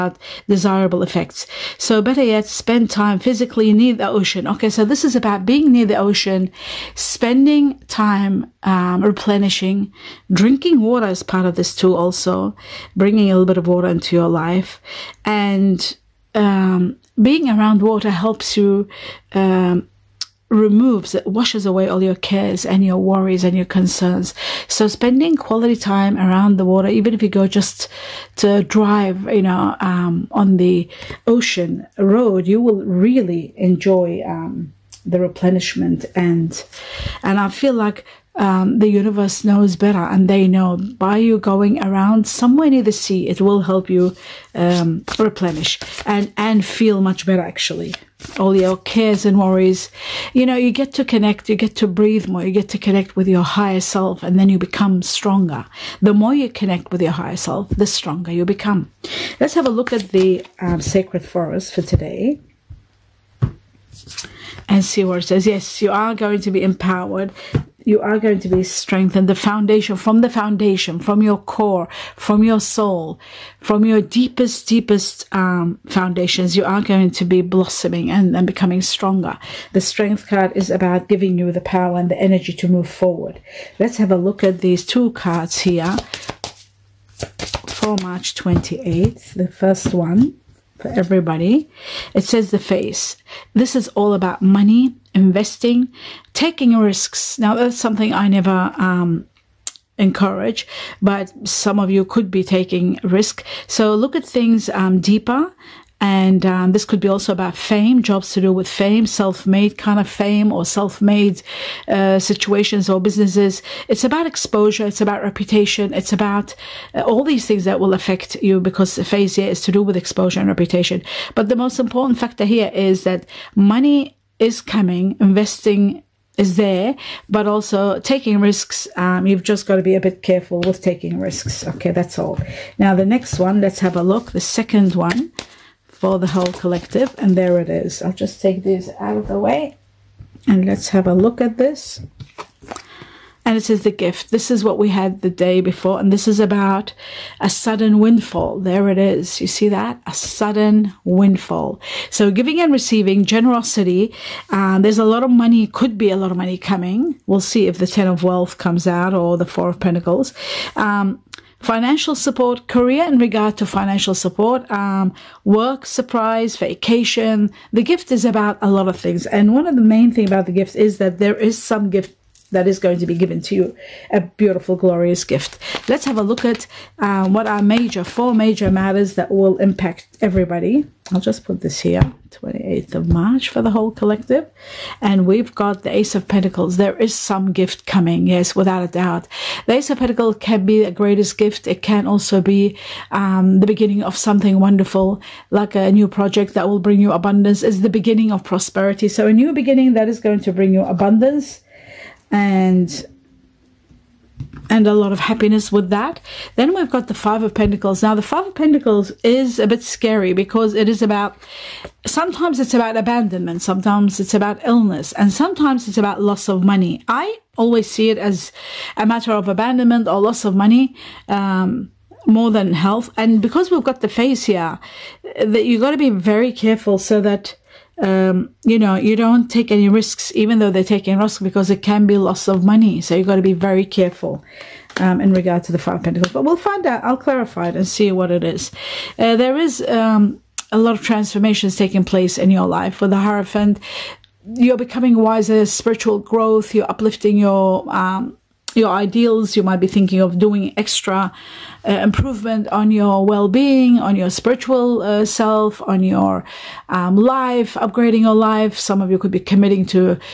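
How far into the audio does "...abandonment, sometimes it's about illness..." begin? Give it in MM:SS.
03:32.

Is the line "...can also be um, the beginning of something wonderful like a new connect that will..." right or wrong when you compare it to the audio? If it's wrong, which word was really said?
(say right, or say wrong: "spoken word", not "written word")
wrong: "project", not "connect".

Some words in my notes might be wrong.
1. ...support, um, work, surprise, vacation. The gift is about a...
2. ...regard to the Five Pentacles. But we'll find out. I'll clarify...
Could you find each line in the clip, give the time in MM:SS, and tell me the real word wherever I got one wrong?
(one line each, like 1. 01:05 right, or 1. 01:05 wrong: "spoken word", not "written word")
1. 02:44 right
2. 03:55 right.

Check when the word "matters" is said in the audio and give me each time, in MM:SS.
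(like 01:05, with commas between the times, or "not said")
02:58, 03:39.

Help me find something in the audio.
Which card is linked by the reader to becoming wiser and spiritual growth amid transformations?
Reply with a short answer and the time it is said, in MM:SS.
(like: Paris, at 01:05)
The Hierophant, at 04:03.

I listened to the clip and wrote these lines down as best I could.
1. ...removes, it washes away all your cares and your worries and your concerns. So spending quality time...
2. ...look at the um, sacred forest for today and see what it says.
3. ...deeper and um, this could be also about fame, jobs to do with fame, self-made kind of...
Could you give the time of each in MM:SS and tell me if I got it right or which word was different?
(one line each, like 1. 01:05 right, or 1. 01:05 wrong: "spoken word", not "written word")
1. 00:20 right
2. 00:59 right
3. 01:45 right.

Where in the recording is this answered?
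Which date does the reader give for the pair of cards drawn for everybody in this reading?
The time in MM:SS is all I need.
01:28.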